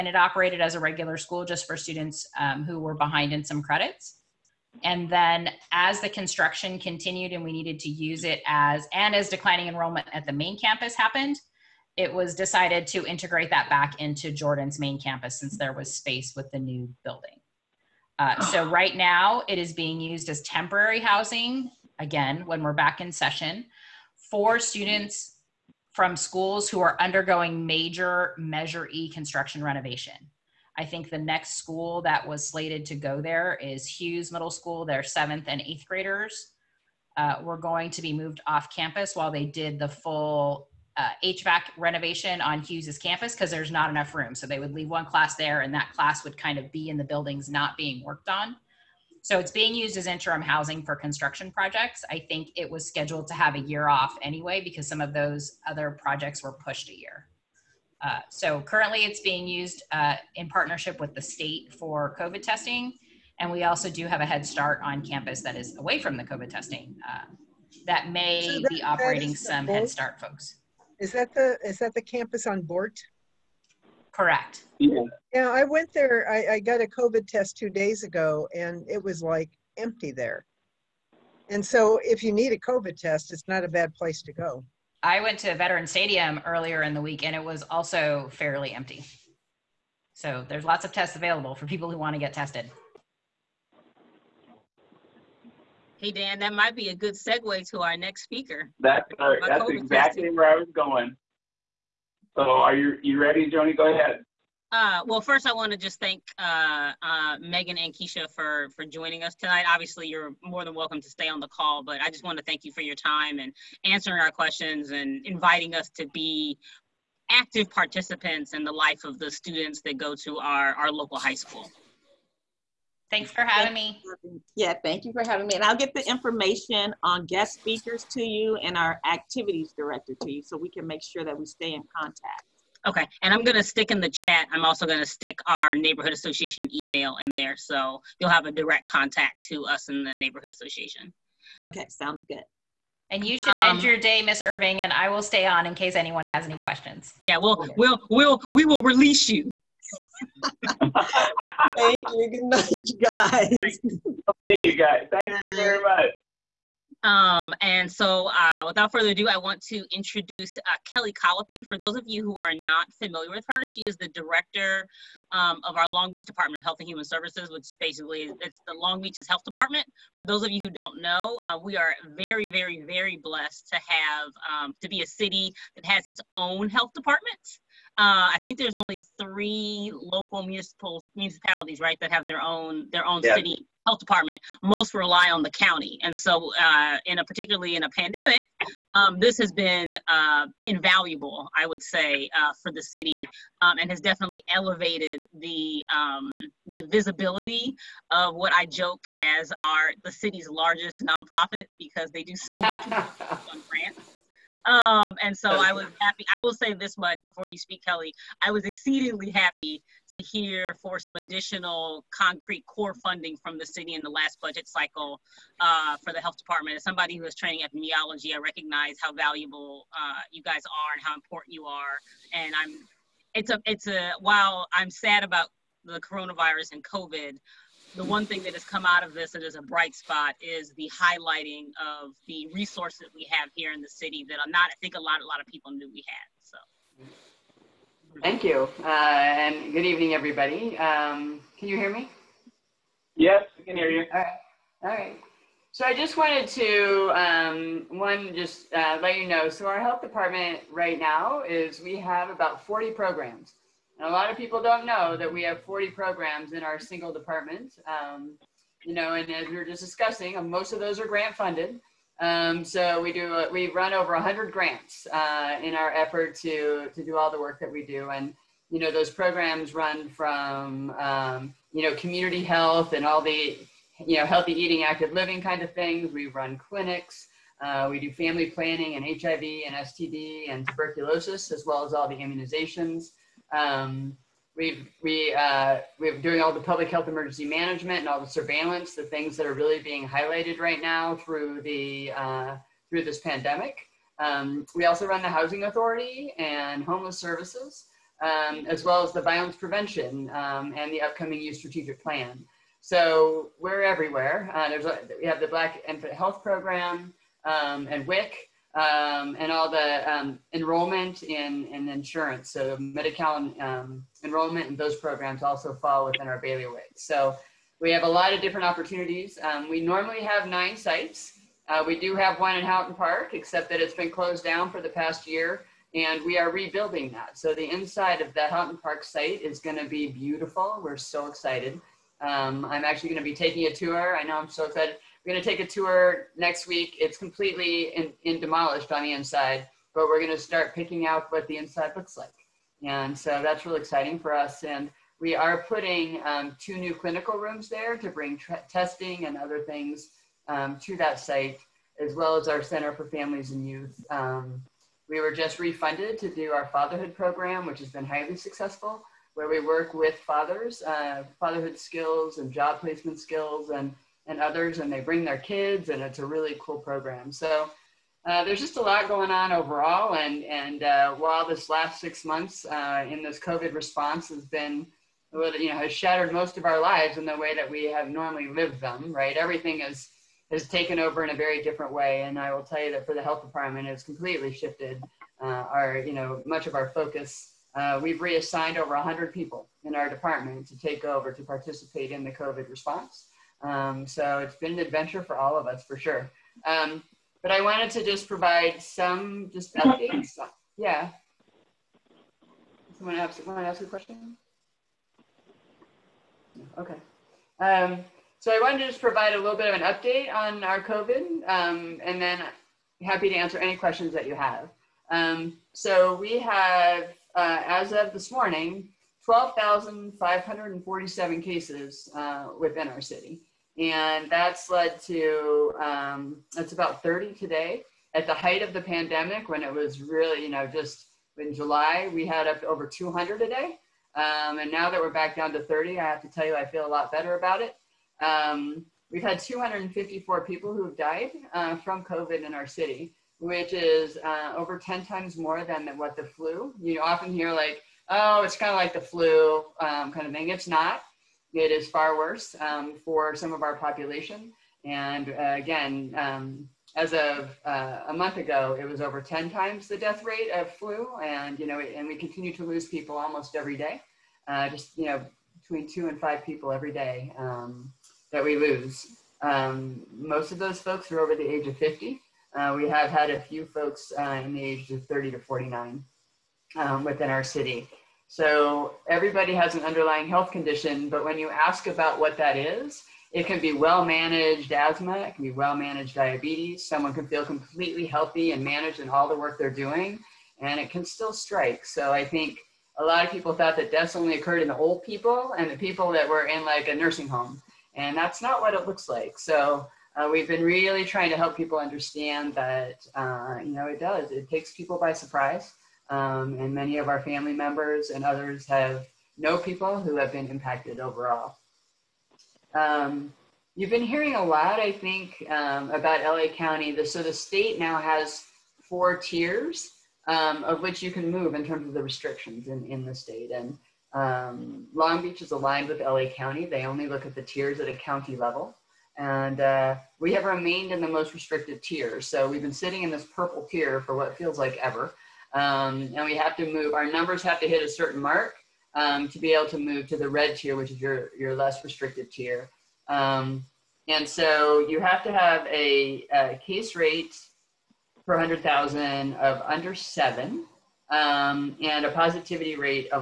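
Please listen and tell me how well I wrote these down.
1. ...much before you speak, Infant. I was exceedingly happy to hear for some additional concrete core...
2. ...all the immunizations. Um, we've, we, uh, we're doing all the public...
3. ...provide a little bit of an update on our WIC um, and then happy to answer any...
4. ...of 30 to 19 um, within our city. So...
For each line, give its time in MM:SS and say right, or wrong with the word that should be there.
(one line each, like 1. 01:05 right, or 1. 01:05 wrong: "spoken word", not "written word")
1. 03:26 wrong: "Kelly", not "Infant"
2. 04:41 right
3. 06:49 wrong: "COVID", not "WIC"
4. 07:54 wrong: "49", not "19".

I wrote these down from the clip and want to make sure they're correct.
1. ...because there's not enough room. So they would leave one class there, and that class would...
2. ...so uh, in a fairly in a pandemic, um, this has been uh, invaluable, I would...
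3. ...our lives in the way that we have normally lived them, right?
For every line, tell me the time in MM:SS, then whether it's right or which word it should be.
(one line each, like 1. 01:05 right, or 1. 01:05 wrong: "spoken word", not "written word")
1. 00:43 right
2. 03:06 wrong: "particularly", not "fairly"
3. 06:16 right.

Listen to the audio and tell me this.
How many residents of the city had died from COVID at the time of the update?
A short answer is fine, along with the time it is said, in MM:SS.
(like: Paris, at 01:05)
254, at 07:19.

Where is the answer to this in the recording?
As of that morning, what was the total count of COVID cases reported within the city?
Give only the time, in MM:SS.
06:59.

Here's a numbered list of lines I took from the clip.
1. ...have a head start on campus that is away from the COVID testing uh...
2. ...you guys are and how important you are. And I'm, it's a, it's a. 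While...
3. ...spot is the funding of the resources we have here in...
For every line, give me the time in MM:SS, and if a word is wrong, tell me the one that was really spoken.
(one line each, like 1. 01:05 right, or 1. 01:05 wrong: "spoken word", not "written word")
1. 01:04 right
2. 03:40 right
3. 03:49 wrong: "highlighting", not "funding".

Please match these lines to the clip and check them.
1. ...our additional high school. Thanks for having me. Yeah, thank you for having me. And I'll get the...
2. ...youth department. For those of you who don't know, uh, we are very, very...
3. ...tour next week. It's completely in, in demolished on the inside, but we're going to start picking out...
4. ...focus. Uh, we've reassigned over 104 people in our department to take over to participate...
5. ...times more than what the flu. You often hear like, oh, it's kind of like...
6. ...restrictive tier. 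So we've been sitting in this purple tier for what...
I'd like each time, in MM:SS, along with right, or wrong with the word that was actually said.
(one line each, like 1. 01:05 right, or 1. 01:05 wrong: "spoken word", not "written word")
1. 02:00 wrong: "local", not "additional"
2. 02:49 wrong: "health", not "youth"
3. 05:35 right
4. 06:26 wrong: "100", not "104"
5. 07:25 right
6. 08:51 right.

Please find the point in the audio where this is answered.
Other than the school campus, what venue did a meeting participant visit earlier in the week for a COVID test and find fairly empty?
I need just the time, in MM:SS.
01:25.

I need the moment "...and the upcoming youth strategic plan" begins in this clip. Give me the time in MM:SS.
05:00.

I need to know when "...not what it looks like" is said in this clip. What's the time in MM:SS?
08:18.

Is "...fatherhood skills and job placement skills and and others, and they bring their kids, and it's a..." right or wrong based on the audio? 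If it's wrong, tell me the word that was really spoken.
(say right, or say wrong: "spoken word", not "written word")
right.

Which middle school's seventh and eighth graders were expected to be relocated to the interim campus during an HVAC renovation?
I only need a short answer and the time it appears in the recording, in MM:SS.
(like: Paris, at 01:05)
Hughes Middle School, at 00:33.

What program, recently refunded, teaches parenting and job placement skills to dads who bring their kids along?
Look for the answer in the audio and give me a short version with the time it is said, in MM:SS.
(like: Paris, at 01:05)
fatherhood program, at 05:56.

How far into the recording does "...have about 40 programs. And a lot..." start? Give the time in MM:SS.
04:11.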